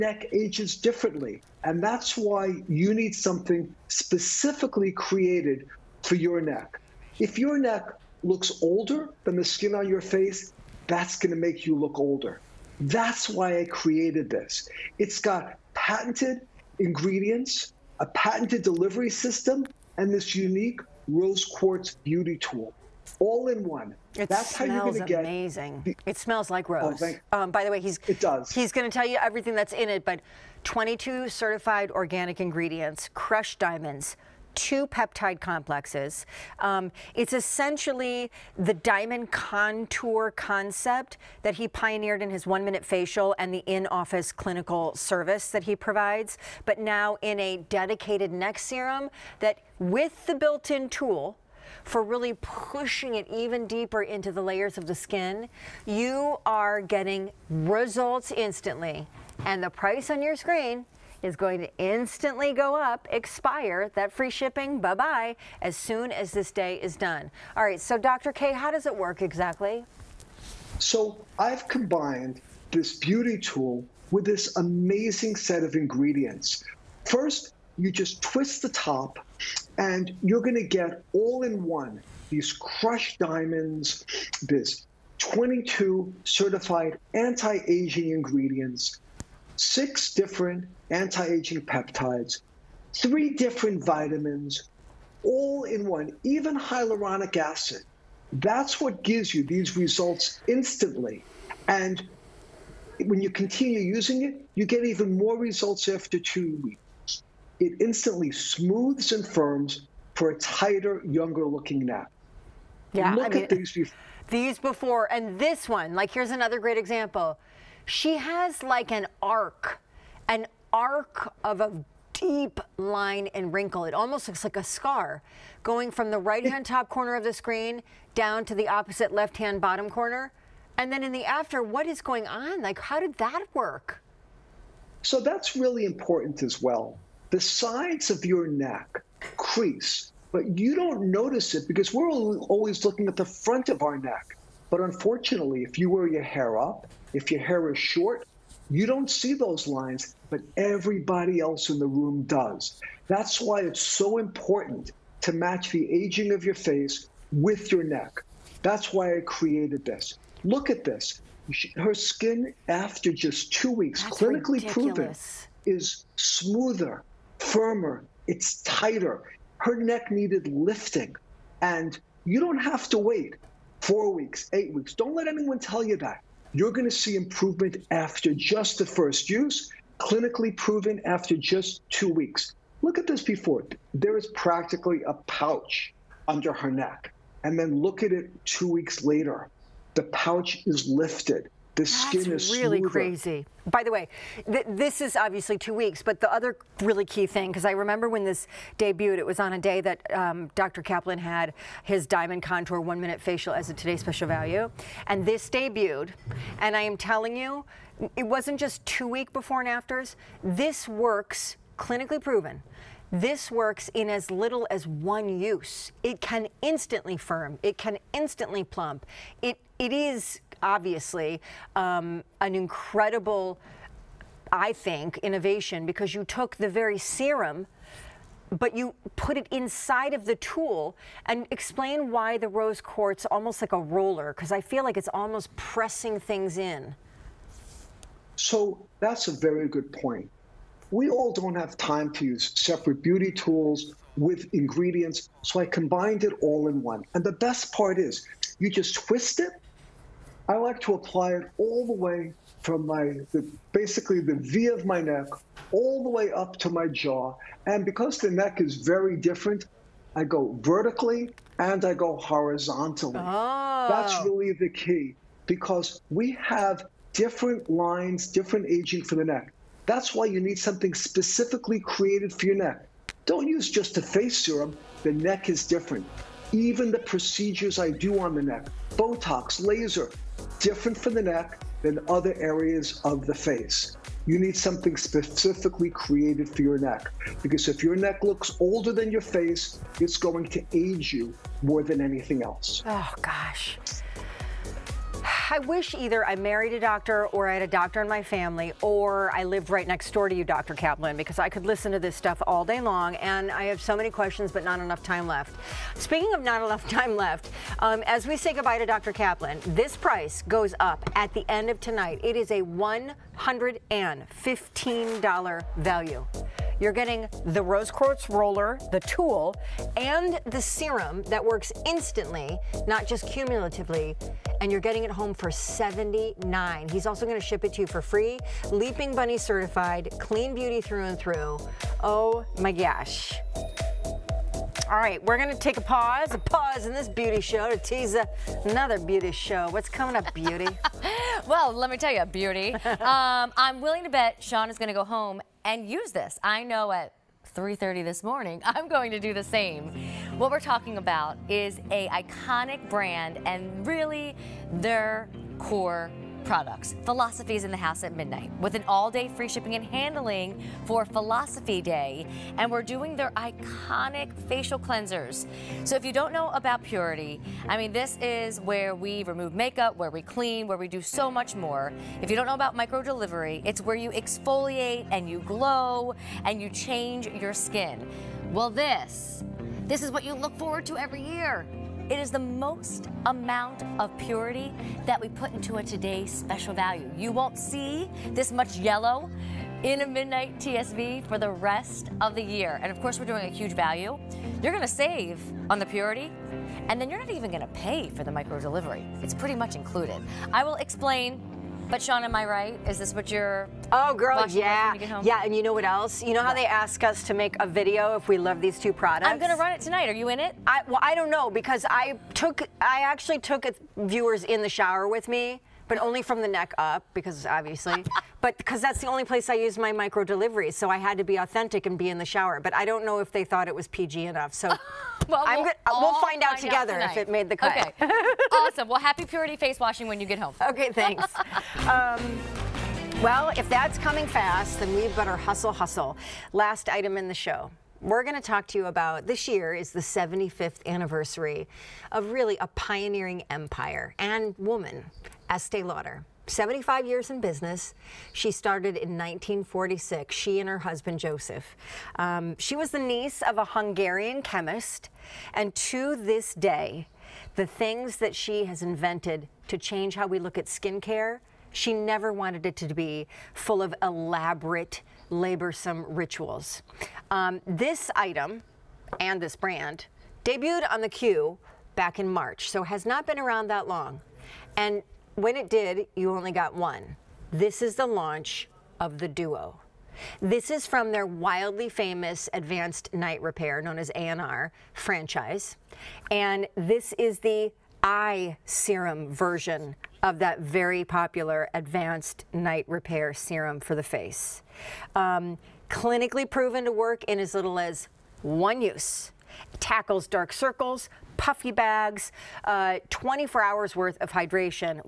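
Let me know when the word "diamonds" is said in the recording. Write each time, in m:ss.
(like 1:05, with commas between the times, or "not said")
0:33, 0:38, 1:23, 3:22.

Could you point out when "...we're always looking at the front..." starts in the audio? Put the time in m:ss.
2:21.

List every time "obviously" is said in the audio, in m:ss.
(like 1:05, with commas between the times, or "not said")
3:15, 3:40, 6:57.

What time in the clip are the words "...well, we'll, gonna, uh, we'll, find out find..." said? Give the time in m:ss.
7:04.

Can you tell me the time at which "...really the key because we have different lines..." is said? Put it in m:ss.
4:24.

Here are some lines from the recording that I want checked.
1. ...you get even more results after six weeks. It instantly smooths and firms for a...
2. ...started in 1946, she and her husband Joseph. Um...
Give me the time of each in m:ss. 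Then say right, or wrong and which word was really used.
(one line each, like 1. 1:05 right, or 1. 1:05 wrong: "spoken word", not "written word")
1. 1:44 wrong: "two", not "six"
2. 7:28 right.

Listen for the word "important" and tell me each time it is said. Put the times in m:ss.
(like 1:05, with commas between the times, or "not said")
2:15, 2:34.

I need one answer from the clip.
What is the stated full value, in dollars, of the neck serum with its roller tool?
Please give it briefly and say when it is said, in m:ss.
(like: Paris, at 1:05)
$115, at 5:12.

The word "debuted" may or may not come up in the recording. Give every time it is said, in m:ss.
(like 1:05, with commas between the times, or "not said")
3:18, 3:25, 7:50.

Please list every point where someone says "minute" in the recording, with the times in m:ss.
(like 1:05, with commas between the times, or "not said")
0:42, 3:23.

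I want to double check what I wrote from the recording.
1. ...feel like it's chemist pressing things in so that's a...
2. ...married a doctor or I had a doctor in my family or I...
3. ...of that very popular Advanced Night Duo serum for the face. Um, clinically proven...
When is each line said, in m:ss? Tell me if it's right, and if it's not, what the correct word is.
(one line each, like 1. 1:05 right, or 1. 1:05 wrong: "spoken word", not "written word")
1. 3:54 wrong: "almost", not "chemist"
2. 4:56 right
3. 8:10 wrong: "Repair", not "Duo".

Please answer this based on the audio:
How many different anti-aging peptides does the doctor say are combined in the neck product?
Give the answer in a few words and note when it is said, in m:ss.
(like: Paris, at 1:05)
6, at 1:29.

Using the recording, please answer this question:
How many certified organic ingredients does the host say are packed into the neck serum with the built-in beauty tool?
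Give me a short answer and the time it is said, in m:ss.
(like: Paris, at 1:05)
22, at 0:30.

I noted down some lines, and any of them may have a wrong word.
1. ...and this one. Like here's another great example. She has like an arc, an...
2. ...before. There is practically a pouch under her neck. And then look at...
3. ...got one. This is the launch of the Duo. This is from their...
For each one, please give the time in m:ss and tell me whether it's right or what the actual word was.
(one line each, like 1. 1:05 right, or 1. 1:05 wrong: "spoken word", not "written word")
1. 1:55 right
2. 3:03 right
3. 7:56 right.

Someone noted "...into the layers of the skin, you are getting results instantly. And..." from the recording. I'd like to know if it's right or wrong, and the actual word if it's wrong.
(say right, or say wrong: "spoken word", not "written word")
right.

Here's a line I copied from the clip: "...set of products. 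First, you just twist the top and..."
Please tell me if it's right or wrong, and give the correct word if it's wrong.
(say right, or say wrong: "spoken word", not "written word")
wrong: "ingredients", not "products".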